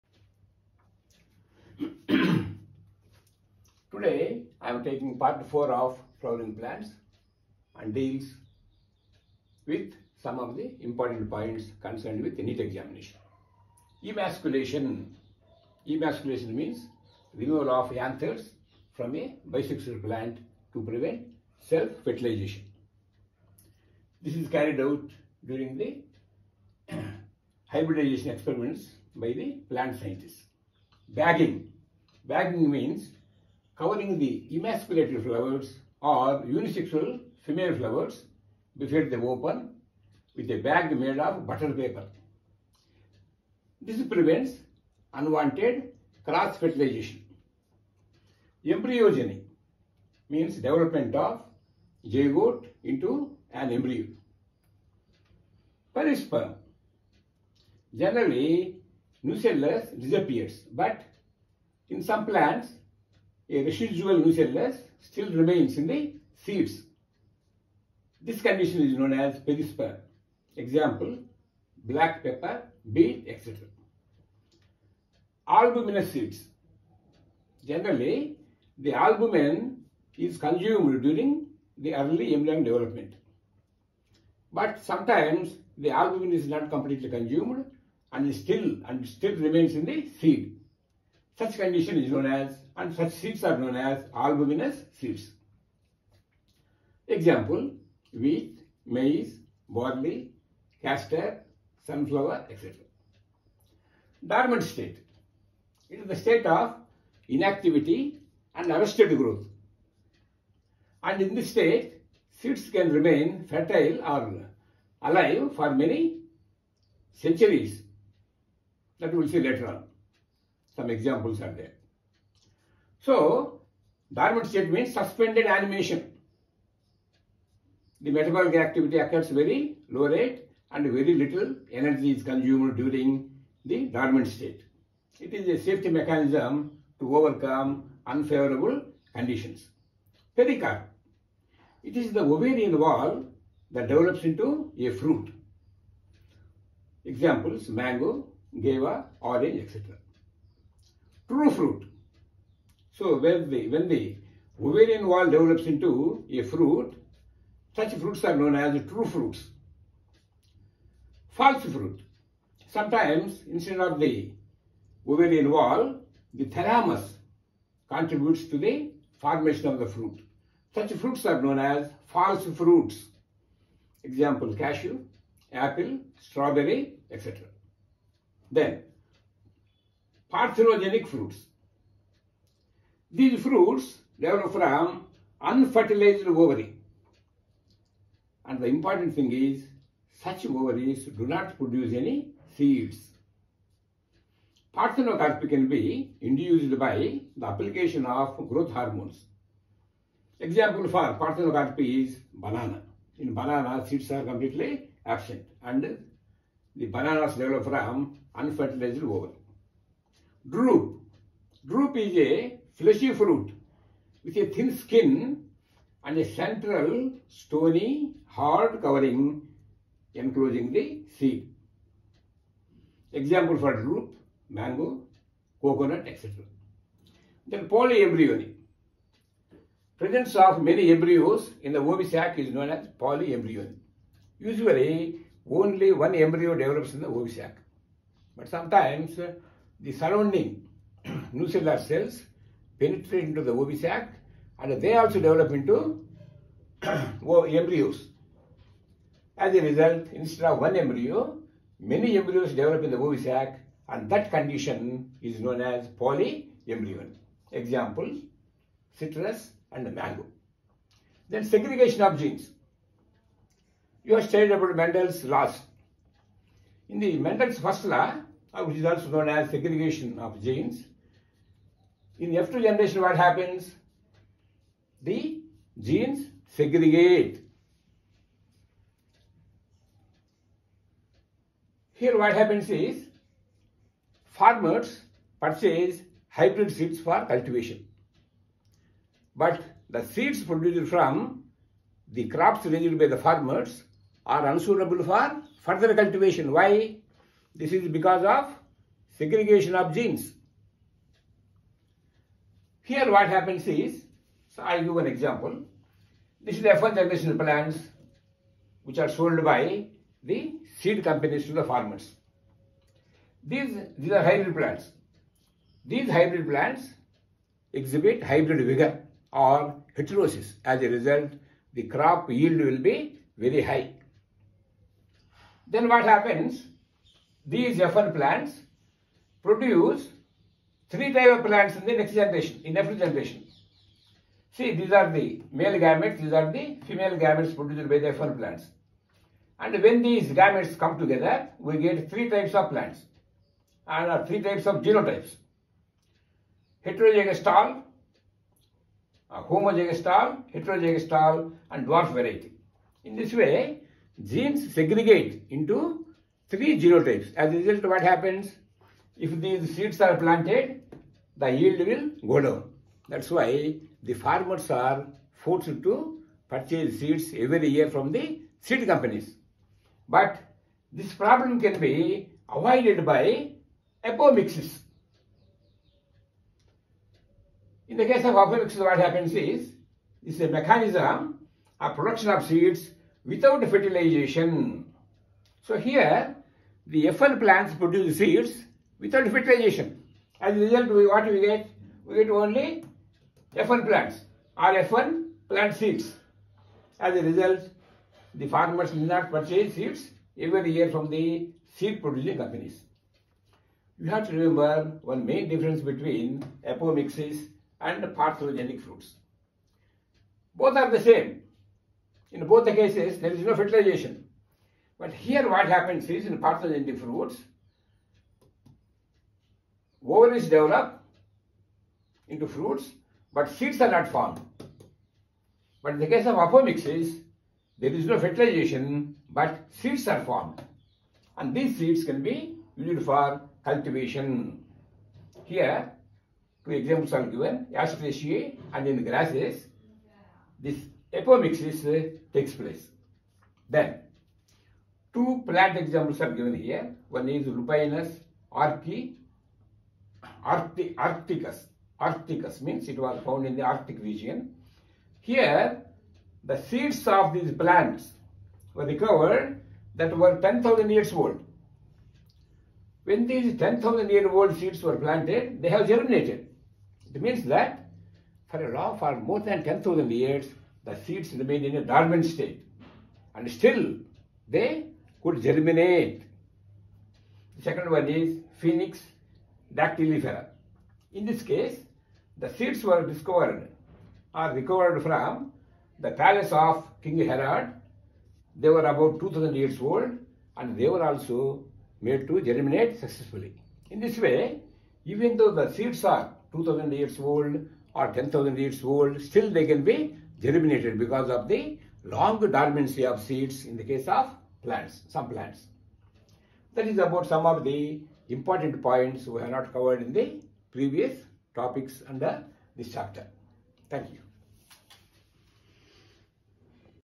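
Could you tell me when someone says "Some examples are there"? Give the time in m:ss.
2:00.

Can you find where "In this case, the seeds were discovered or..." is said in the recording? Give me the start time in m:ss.
8:01.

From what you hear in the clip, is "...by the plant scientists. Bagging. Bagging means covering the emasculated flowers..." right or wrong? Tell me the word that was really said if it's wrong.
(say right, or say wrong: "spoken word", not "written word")
right.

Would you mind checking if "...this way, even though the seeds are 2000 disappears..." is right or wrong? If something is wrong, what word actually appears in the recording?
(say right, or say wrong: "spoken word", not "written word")
wrong: "years", not "disappears".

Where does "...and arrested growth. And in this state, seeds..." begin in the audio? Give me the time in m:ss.
1:48.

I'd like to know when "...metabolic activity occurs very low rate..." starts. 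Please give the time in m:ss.
2:08.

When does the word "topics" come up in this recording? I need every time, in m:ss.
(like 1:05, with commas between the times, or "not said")
8:31.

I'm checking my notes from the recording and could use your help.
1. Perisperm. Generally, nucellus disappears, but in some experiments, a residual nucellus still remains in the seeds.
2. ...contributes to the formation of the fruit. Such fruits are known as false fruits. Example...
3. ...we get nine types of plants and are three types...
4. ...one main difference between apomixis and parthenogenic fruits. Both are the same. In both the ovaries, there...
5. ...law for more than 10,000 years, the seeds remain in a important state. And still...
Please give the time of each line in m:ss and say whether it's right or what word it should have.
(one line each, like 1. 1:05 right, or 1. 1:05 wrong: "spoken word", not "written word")
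1. 0:55 wrong: "plants", not "experiments"
2. 2:47 right
3. 5:41 wrong: "three", not "nine"
4. 6:45 wrong: "cases", not "ovaries"
5. 7:48 wrong: "dormant", not "important".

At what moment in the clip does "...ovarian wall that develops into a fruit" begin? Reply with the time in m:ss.
2:22.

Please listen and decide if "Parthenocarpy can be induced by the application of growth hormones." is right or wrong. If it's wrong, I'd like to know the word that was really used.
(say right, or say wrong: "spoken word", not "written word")
right.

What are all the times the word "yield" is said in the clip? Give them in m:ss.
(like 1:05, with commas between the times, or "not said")
5:22, 6:01.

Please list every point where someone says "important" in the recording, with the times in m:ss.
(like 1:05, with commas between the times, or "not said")
0:10, 3:08, 8:28.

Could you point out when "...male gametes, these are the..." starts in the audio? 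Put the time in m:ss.
5:35.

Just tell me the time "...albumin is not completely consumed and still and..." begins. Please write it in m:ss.
1:25.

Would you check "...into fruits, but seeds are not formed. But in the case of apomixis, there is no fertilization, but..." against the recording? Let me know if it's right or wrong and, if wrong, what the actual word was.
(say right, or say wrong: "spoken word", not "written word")
right.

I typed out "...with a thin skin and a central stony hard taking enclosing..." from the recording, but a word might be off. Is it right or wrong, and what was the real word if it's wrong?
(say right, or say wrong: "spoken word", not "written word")
wrong: "covering", not "taking".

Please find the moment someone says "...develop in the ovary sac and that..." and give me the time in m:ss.
4:12.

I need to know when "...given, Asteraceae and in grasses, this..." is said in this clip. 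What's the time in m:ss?
7:17.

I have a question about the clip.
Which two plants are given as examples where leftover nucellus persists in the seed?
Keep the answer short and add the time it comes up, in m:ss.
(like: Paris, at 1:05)
Black pepper, beet, at 1:11.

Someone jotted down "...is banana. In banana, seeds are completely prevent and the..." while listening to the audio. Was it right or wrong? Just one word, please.
wrong.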